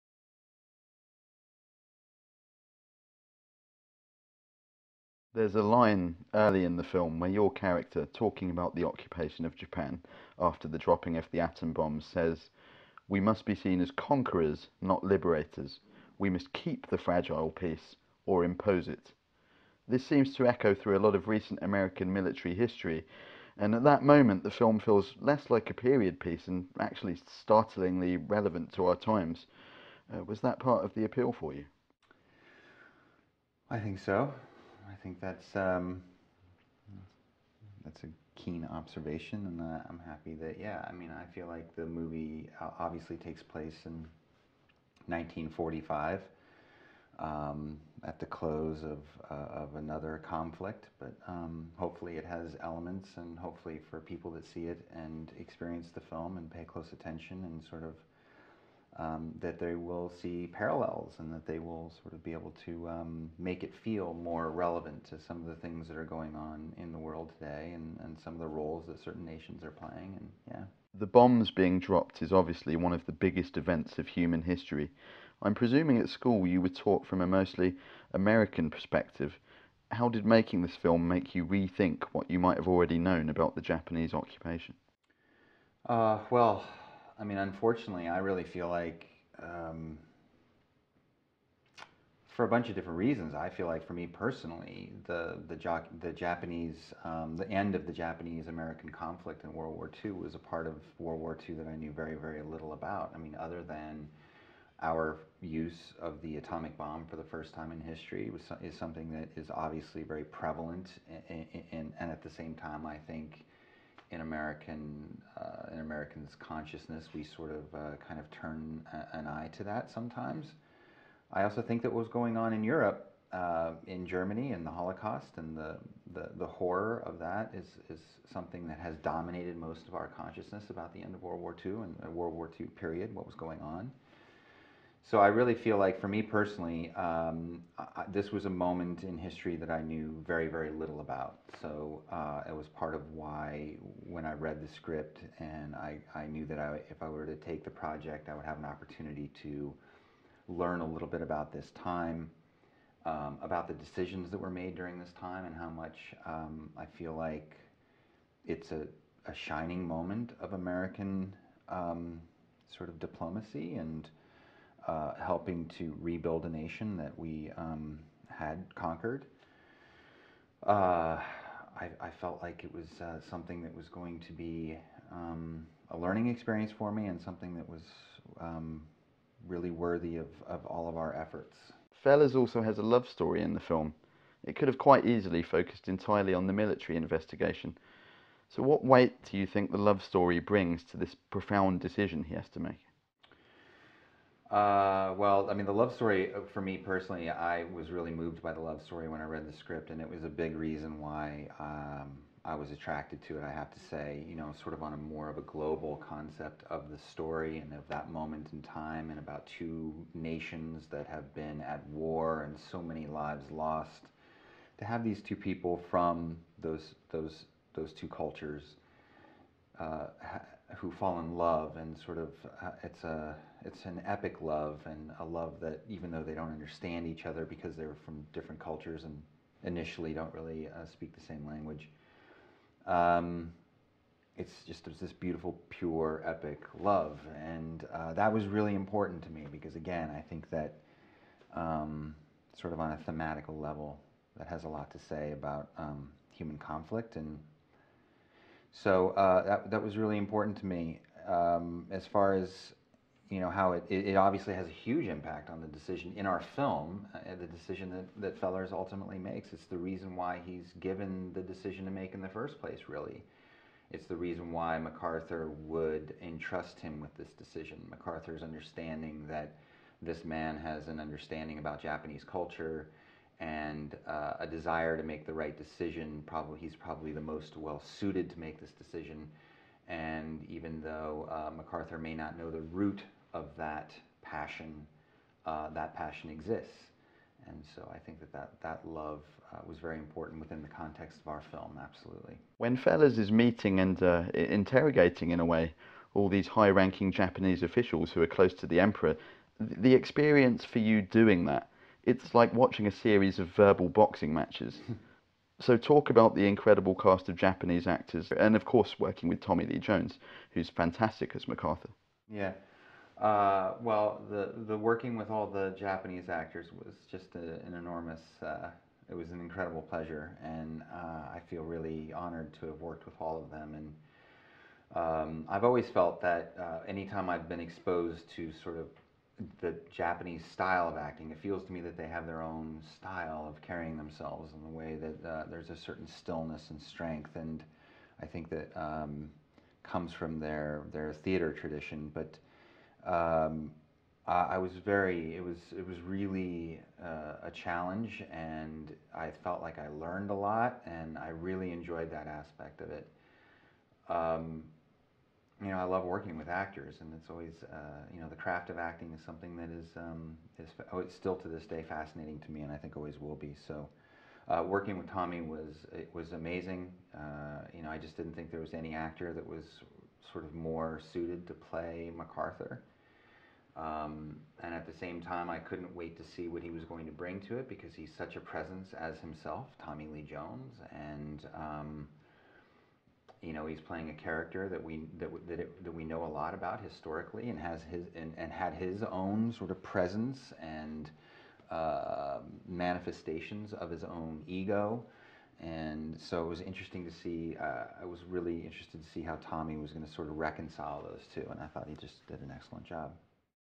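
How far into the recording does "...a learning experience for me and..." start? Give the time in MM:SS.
02:55.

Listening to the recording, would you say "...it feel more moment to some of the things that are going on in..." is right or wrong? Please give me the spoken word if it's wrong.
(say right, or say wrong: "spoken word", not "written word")
wrong: "relevant", not "moment".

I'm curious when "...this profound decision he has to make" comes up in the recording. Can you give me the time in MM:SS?
03:10.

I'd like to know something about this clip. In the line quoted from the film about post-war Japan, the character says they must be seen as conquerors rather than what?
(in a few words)
liberators.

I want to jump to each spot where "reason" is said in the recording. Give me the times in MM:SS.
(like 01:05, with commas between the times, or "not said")
01:32, 03:20, 04:19, 04:24.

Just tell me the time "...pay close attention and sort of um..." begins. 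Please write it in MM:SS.
00:56.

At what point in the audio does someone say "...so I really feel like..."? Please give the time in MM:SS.
02:15.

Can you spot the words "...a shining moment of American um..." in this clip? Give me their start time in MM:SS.
02:39.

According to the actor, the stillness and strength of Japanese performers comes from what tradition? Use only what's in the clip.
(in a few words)
theater tradition.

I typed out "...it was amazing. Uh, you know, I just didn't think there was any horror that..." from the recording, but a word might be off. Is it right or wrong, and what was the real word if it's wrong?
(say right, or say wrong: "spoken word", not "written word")
wrong: "actor", not "horror".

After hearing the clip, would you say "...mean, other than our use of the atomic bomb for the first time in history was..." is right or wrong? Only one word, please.
right.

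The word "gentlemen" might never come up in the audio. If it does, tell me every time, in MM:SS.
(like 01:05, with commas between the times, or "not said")
not said.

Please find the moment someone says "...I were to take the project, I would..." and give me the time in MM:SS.
02:27.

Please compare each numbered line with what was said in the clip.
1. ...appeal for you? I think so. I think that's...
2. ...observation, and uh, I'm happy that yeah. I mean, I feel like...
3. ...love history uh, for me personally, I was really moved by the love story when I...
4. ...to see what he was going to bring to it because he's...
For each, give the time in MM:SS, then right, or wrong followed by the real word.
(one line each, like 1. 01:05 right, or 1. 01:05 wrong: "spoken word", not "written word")
1. 00:31 right
2. 00:38 right
3. 03:15 wrong: "story", not "history"
4. 06:16 right.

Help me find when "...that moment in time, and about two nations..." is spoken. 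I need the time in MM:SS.
03:27.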